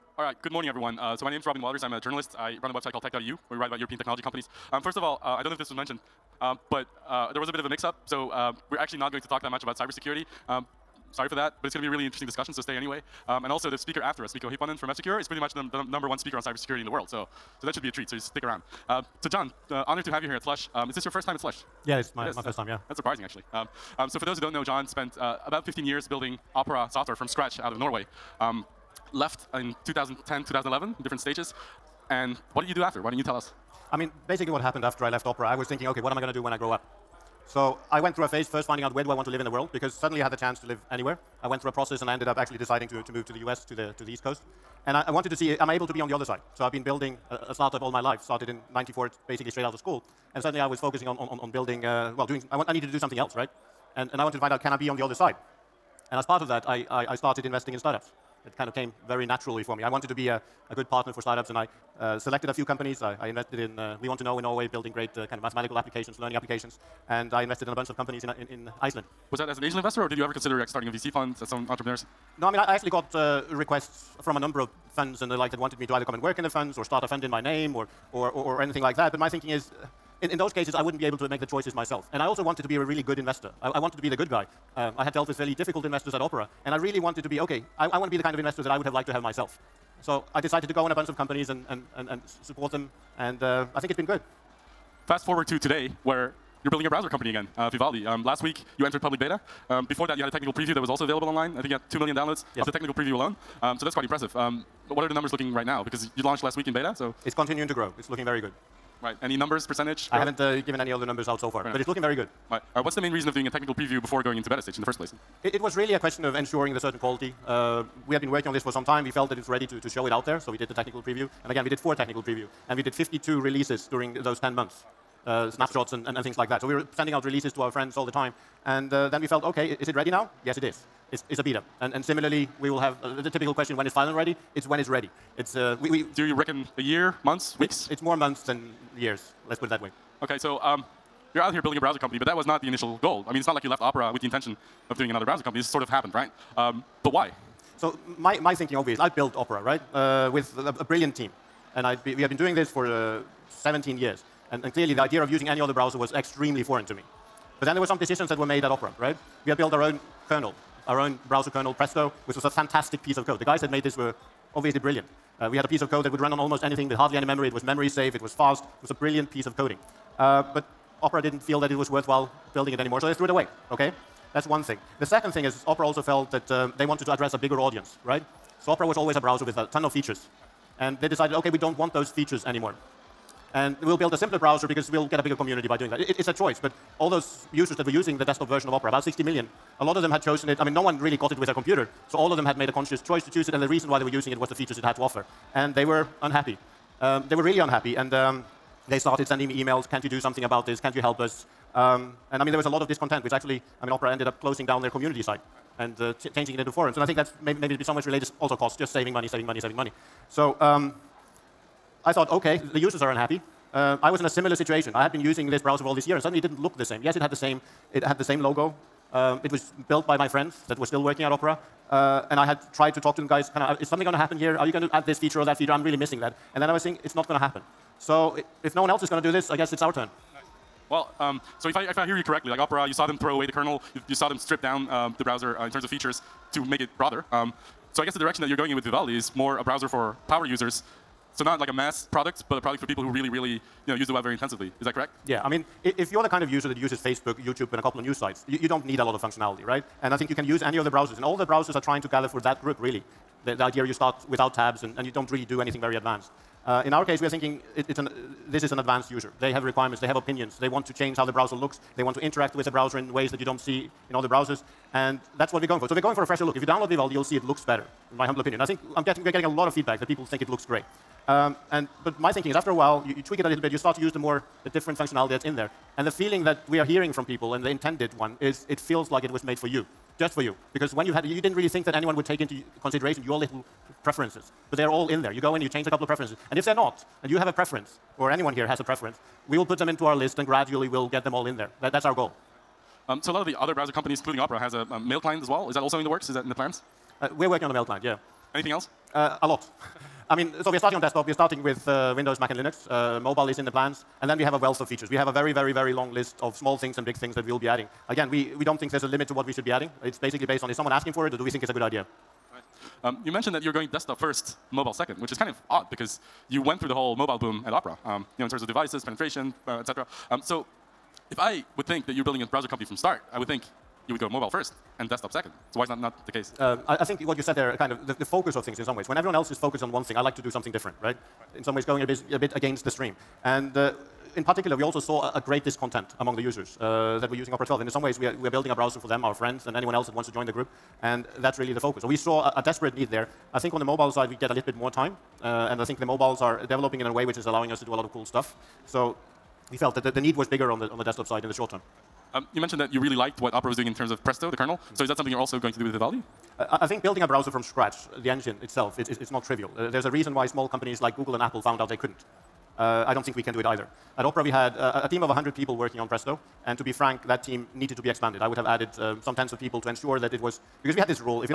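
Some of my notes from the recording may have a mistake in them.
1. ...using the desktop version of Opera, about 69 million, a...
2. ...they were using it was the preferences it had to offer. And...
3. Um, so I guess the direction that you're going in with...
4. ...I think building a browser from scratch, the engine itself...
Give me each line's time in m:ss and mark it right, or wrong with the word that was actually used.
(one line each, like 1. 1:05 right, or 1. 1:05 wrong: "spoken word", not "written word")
1. 3:07 wrong: "60", not "69"
2. 3:13 wrong: "features", not "preferences"
3. 3:57 right
4. 5:56 right.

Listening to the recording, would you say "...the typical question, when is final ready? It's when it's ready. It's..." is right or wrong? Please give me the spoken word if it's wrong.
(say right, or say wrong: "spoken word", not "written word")
right.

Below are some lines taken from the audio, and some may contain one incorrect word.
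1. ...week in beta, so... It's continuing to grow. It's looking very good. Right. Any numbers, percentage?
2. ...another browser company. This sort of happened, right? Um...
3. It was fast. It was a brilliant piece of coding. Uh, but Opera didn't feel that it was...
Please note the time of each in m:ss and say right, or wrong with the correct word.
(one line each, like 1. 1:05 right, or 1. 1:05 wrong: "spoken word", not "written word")
1. 1:46 right
2. 2:25 right
3. 2:48 right.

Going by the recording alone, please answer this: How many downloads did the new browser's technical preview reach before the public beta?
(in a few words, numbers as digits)
2 million.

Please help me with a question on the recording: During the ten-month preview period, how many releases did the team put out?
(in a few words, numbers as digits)
52.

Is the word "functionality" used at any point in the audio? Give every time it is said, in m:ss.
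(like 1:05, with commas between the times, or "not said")
4:09, 4:34.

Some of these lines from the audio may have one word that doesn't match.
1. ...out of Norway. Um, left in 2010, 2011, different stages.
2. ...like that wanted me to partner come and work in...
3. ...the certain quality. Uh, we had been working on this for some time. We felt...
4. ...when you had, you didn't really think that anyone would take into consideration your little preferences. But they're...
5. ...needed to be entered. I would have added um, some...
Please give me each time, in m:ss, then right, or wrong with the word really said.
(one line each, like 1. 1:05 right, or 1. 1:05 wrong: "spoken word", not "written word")
1. 0:27 right
2. 1:15 wrong: "either", not "partner"
3. 1:56 right
4. 4:40 right
5. 6:07 wrong: "expanded", not "entered".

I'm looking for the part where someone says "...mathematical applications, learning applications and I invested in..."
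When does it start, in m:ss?
1:05.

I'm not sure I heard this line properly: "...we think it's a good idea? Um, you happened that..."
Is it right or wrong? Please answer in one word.
wrong.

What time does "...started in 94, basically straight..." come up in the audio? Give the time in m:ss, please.
0:48.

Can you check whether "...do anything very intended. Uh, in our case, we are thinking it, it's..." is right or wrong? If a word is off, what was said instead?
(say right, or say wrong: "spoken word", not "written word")
wrong: "advanced", not "intended".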